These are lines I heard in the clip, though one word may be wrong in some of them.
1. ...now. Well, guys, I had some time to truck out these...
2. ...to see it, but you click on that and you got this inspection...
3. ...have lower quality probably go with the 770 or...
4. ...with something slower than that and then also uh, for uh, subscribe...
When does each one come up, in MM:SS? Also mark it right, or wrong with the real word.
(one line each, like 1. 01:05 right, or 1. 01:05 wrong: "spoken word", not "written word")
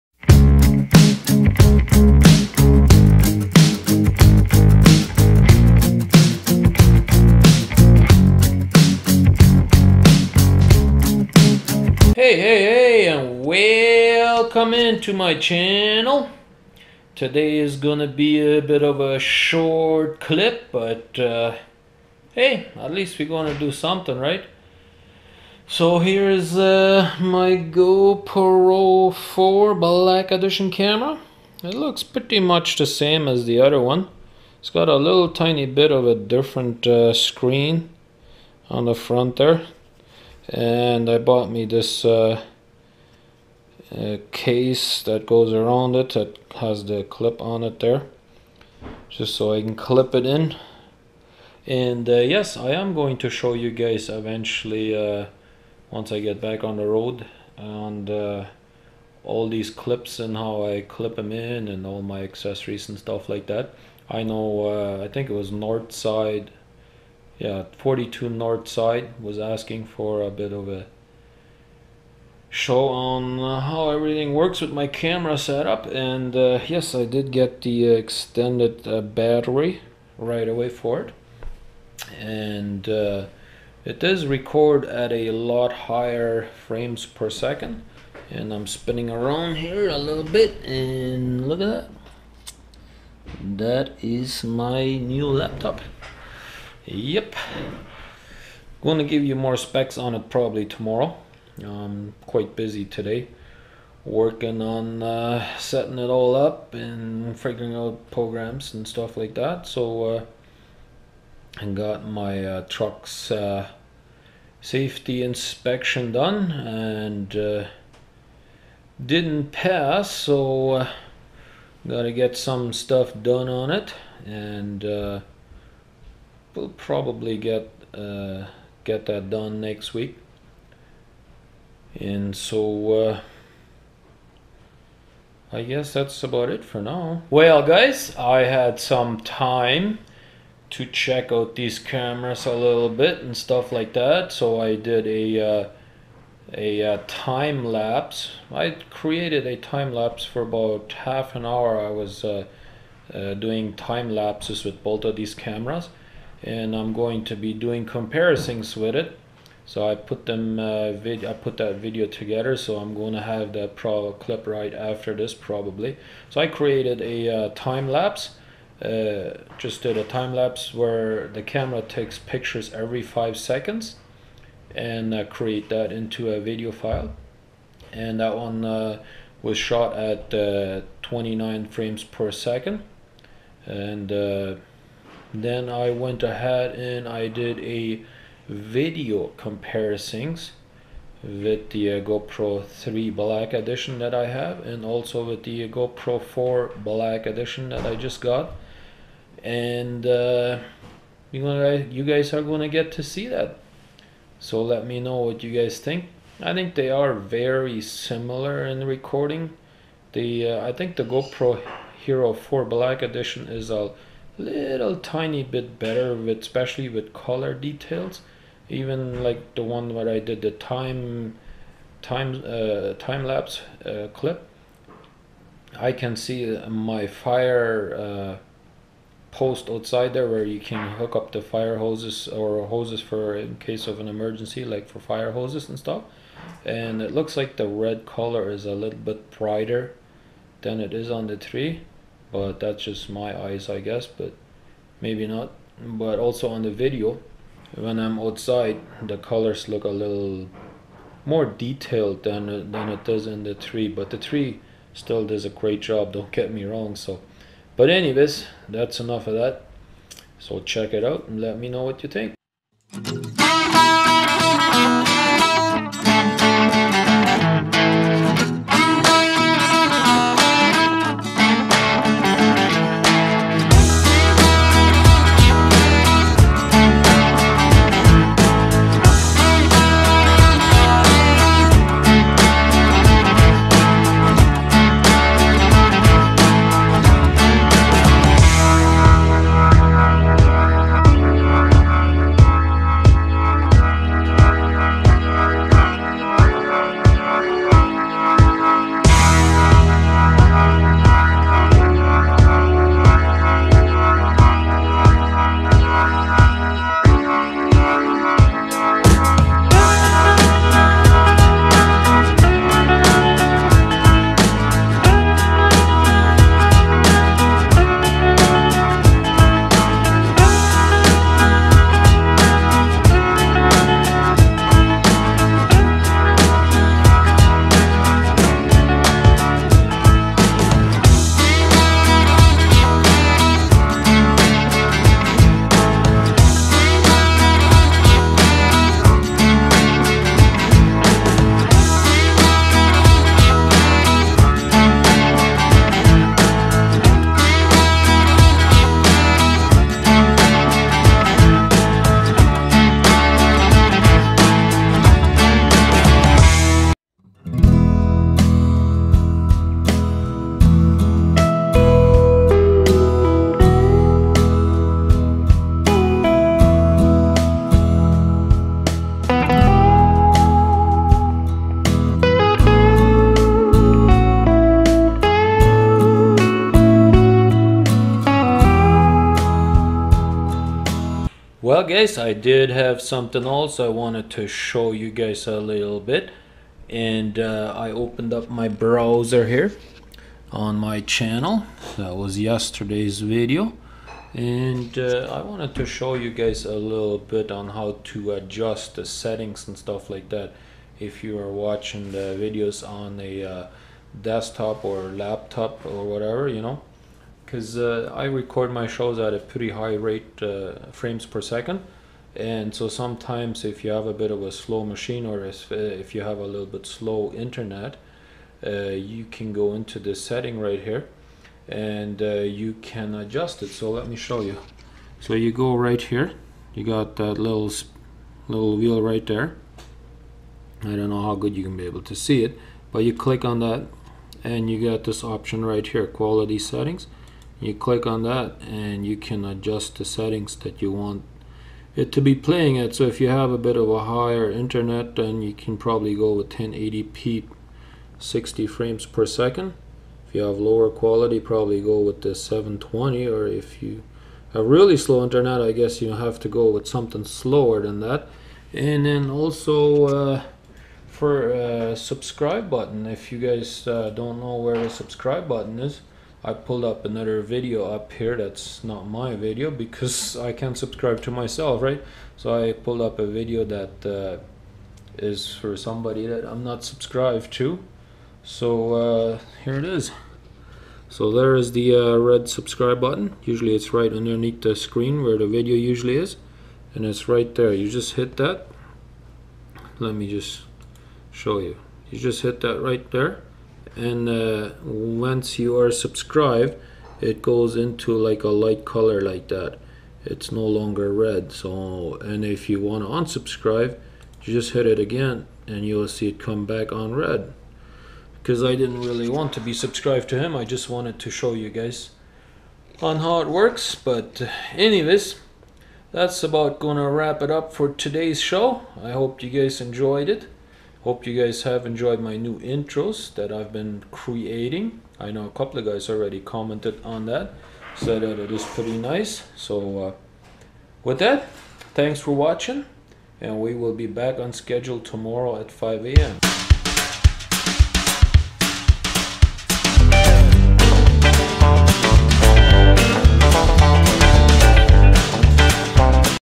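1. 02:16 wrong: "check", not "truck"
2. 07:12 wrong: "option", not "inspection"
3. 07:30 wrong: "720", not "770"
4. 07:36 right.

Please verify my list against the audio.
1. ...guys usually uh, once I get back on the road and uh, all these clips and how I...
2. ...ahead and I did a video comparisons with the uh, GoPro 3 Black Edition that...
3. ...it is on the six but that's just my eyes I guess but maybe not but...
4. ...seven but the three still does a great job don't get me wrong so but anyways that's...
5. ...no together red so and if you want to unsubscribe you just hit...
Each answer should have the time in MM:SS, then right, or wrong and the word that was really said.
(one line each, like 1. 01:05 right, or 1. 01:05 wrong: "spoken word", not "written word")
1. 00:53 wrong: "eventually", not "usually"
2. 03:06 right
3. 04:00 wrong: "three", not "six"
4. 04:13 wrong: "three", not "seven"
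5. 08:20 wrong: "longer", not "together".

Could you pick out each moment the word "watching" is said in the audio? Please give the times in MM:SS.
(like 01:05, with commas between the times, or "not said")
06:41, 08:52.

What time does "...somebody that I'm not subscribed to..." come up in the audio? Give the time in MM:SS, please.
07:55.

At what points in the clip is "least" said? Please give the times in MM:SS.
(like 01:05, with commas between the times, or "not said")
00:22.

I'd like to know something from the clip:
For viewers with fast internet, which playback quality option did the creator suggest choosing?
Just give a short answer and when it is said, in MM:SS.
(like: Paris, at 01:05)
1080p 60 frames per second, at 07:26.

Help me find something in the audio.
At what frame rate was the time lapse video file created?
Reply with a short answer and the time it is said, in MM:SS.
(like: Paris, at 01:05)
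29 frames per second, at 03:01.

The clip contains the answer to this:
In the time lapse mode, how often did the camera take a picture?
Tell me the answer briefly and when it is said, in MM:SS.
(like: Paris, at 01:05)
every 5 seconds, at 02:52.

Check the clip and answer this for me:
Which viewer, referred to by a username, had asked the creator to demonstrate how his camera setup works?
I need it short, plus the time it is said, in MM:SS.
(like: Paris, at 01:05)
42 north side, at 01:07.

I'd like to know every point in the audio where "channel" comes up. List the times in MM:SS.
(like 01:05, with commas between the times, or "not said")
00:15, 06:30.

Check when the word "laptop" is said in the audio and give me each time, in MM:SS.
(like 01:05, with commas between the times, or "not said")
01:35, 06:45.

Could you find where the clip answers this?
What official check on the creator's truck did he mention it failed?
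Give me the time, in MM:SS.
01:54.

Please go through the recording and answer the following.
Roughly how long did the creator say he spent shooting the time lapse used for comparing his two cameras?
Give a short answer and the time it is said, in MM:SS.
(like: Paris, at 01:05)
half an hour, at 02:30.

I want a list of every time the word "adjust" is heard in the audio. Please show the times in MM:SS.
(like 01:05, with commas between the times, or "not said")
06:38, 07:03, 07:19.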